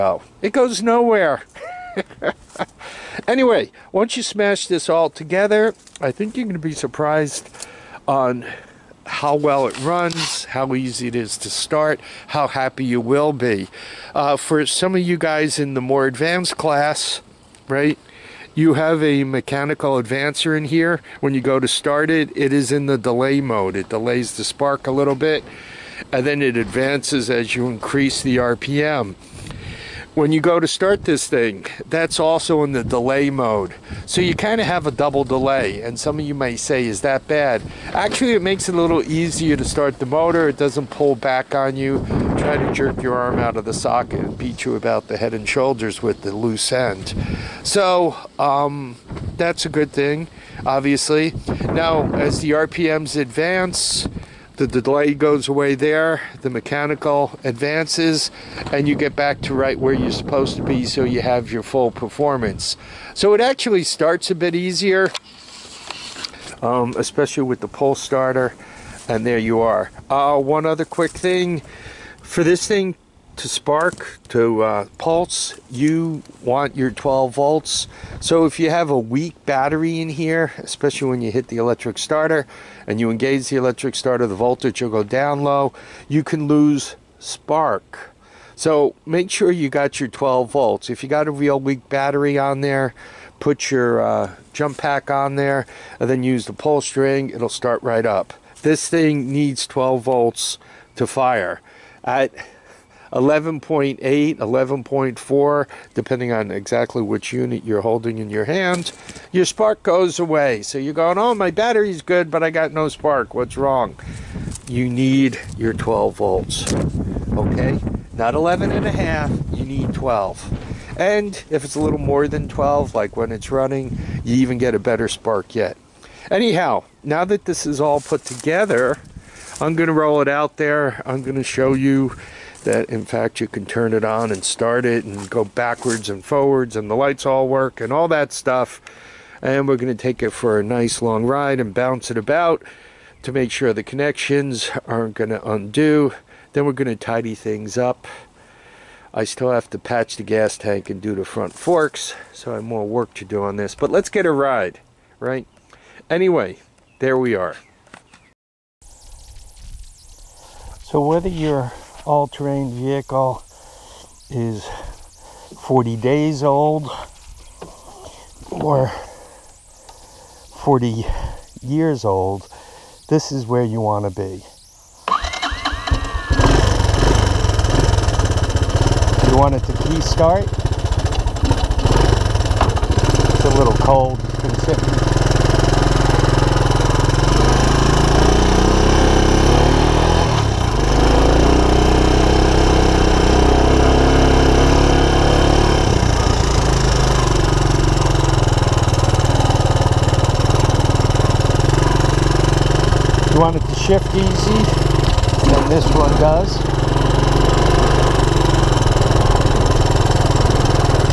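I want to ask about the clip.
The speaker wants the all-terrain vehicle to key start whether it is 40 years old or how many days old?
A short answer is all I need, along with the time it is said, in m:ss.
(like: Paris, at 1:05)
40 days, at 2:45.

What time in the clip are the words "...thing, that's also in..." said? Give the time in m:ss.
0:31.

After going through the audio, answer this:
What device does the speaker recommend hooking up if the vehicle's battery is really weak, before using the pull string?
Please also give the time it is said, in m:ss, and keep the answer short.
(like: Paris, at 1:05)
jump pack, at 1:34.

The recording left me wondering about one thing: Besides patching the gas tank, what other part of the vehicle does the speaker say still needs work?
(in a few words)
front forks.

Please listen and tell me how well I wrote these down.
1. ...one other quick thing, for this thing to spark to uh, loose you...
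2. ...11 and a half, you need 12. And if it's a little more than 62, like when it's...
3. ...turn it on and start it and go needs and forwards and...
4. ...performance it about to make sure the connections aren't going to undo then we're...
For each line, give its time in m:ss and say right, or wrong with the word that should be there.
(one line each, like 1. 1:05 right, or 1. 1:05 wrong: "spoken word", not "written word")
1. 1:10 wrong: "pulse", not "loose"
2. 1:58 wrong: "12", not "62"
3. 2:13 wrong: "backwards", not "needs"
4. 2:21 wrong: "bounce", not "performance".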